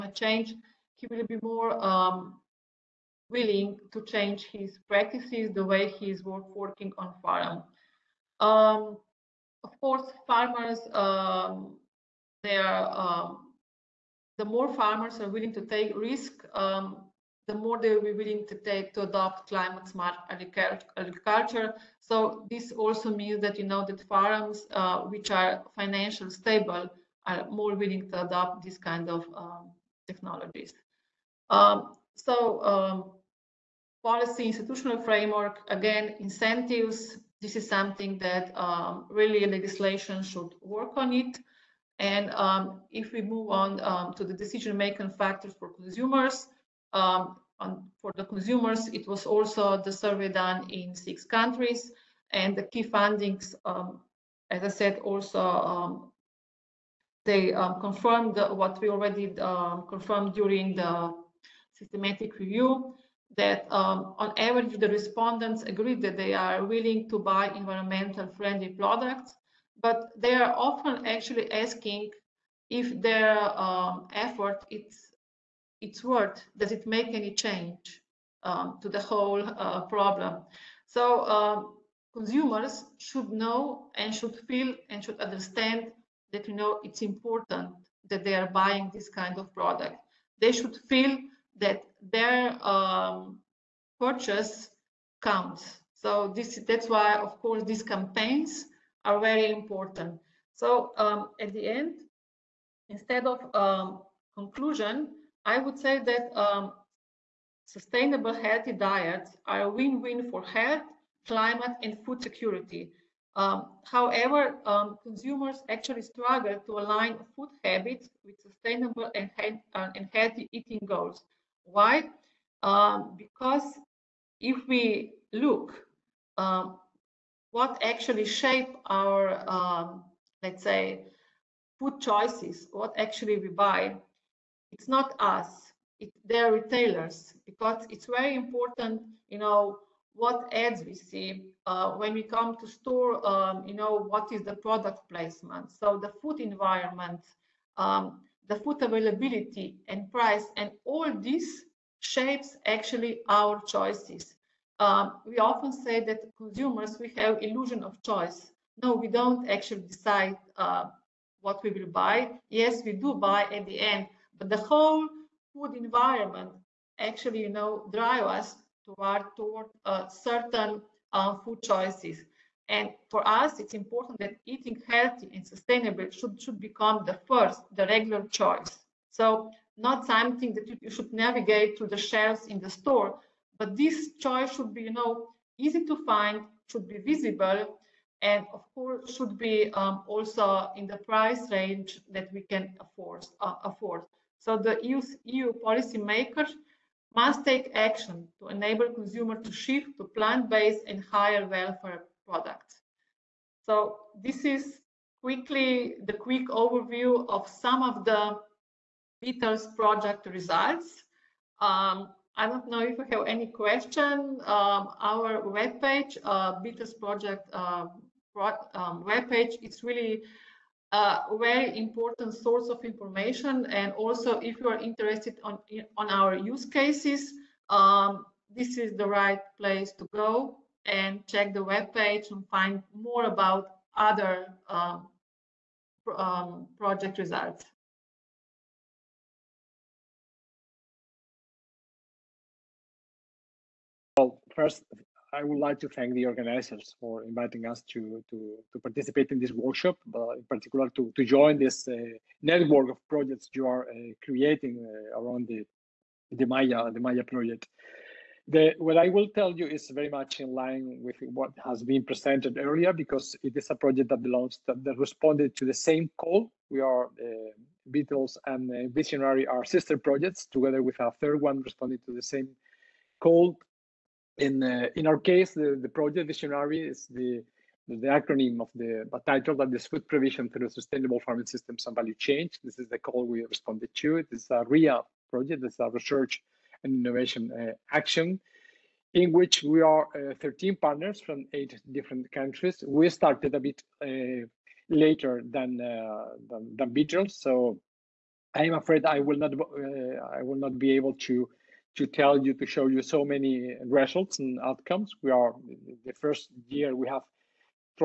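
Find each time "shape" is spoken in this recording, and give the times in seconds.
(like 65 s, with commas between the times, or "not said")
128 s, 151 s.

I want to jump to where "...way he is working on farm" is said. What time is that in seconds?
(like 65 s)
5 s.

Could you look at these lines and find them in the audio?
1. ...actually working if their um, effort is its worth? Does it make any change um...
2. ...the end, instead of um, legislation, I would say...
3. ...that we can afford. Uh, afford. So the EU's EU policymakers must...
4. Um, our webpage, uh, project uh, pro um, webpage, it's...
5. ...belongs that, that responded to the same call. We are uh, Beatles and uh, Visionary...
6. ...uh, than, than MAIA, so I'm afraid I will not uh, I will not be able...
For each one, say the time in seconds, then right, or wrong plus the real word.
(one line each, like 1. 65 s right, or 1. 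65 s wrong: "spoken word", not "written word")
1. 71 s wrong: "asking", not "working"
2. 101 s wrong: "conclusion", not "legislation"
3. 192 s right
4. 214 s right
5. 264 s right
6. 295 s wrong: "Beatles", not "MAIA".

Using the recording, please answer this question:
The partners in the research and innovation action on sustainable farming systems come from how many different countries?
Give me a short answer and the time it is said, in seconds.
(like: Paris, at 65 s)
8, at 291 s.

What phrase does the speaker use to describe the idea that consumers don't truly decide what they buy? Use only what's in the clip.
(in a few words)
Illusion of choice.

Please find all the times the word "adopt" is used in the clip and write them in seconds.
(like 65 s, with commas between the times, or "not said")
19 s, 28 s.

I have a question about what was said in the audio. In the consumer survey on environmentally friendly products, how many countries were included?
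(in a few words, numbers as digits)
6.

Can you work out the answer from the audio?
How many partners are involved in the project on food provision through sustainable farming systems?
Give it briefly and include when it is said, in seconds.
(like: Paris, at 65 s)
13, at 290 s.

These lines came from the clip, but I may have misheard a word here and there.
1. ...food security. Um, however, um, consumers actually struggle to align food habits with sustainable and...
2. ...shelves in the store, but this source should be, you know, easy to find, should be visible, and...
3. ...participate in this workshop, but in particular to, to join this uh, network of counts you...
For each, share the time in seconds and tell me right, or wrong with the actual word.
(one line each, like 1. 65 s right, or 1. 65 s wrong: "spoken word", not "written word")
1. 112 s right
2. 181 s wrong: "choice", not "source"
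3. 248 s wrong: "projects", not "counts".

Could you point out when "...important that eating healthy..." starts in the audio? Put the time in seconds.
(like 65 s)
173 s.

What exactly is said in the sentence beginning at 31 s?
Um, so um, policy institutional framework, again, incentives, this is something that um, really legislation should work on it.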